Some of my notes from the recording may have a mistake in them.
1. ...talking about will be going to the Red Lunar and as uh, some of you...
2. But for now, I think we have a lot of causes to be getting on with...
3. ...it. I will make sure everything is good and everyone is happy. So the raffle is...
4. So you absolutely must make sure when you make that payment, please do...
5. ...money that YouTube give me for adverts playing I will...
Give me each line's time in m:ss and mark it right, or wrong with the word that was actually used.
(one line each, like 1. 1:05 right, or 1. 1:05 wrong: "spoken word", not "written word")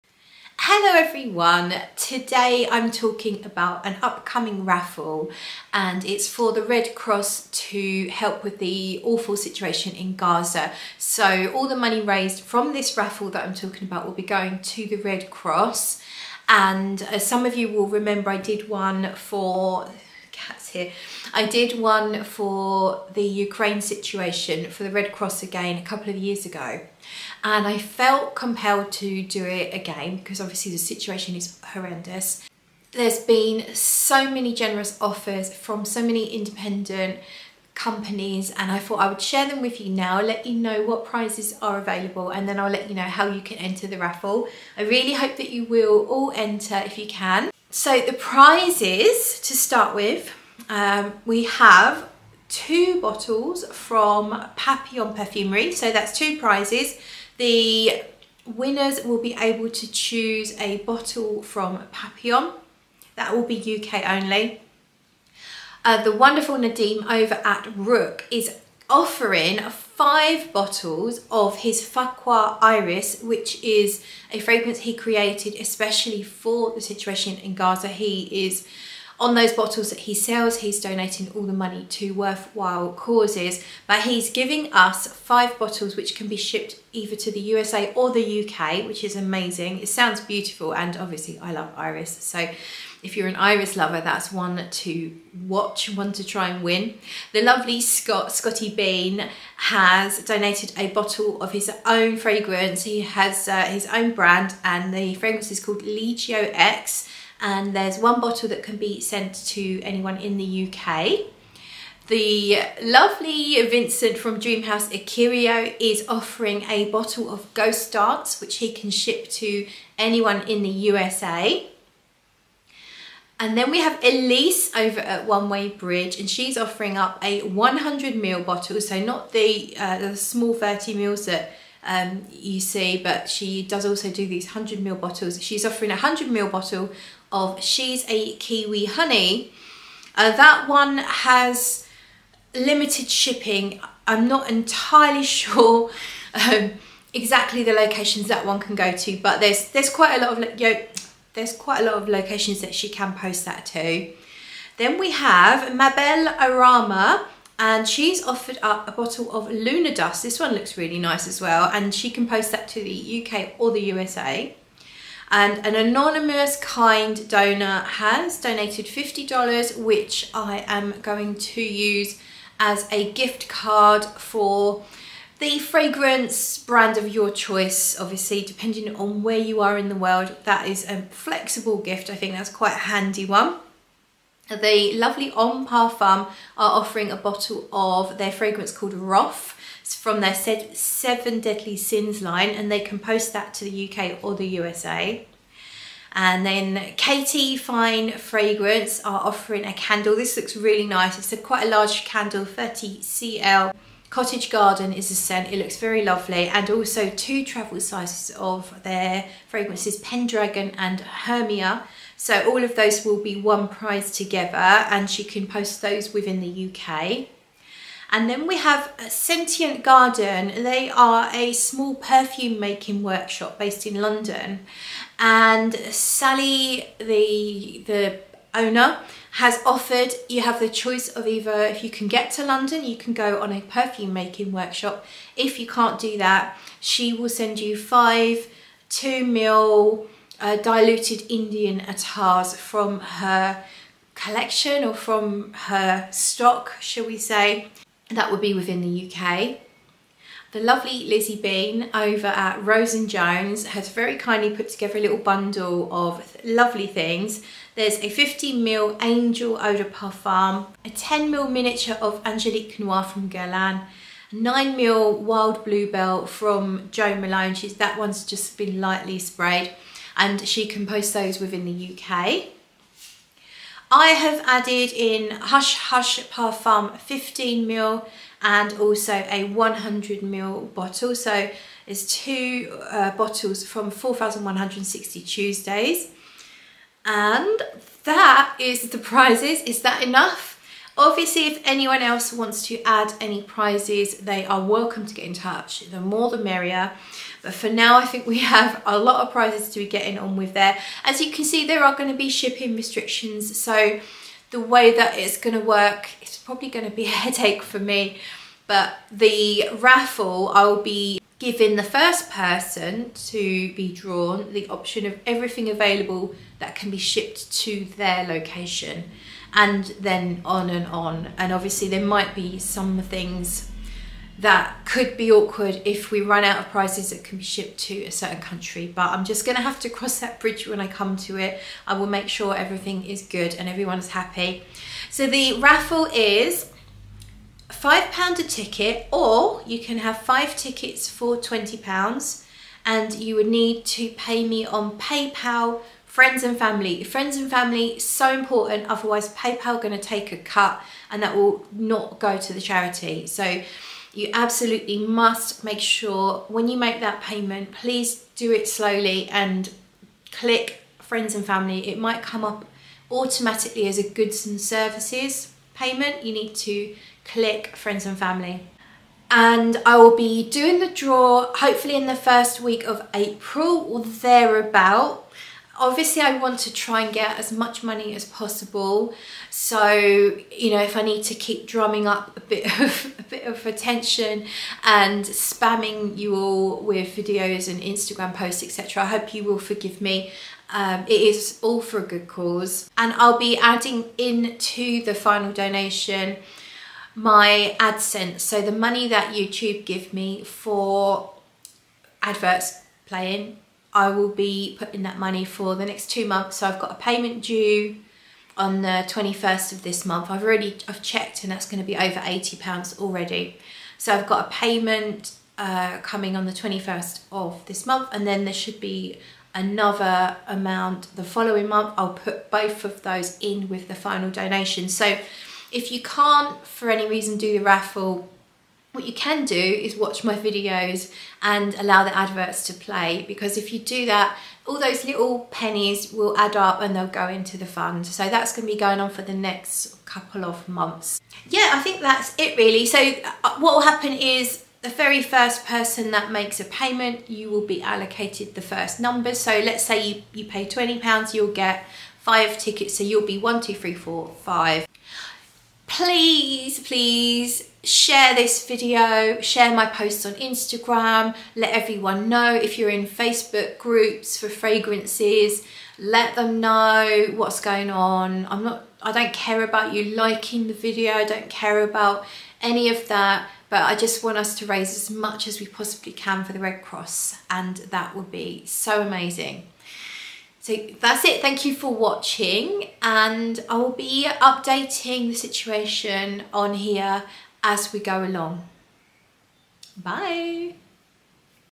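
1. 0:13 wrong: "Cross", not "Lunar"
2. 4:57 wrong: "prizes", not "causes"
3. 5:31 right
4. 5:53 right
5. 6:38 right.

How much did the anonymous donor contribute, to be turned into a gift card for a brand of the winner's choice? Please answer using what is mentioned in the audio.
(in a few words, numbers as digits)
$50.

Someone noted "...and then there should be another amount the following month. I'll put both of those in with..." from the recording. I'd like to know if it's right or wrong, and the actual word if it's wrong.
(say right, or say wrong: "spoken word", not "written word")
right.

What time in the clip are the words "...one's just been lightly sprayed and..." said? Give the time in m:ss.
4:27.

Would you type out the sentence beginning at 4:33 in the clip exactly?
I have added in Hush Hush Parfum 15ml and also a 100ml bottle.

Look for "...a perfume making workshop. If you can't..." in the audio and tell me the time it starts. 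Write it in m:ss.
3:53.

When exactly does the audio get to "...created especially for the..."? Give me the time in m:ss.
1:14.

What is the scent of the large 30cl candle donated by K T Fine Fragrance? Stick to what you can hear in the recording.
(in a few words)
Cottage Garden.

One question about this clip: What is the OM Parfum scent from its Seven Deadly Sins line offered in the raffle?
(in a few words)
Wrath.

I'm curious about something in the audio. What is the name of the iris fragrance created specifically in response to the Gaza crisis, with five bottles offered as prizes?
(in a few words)
Faqqua Iris.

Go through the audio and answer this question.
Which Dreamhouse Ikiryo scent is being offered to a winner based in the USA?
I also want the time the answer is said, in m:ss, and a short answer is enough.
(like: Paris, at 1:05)
Ghost Dance, at 1:57.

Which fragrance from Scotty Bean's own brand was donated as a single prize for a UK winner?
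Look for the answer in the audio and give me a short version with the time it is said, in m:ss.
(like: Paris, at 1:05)
Legio X, at 1:45.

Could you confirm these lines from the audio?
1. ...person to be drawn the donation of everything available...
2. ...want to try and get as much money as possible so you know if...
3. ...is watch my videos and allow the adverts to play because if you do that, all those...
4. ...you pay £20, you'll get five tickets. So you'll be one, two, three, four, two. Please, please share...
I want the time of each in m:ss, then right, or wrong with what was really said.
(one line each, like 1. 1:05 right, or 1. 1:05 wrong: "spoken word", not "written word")
1. 5:12 wrong: "option", not "donation"
2. 6:16 right
3. 7:09 right
4. 7:30 wrong: "five", not "two".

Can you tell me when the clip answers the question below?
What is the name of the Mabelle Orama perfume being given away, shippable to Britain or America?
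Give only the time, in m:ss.
2:39.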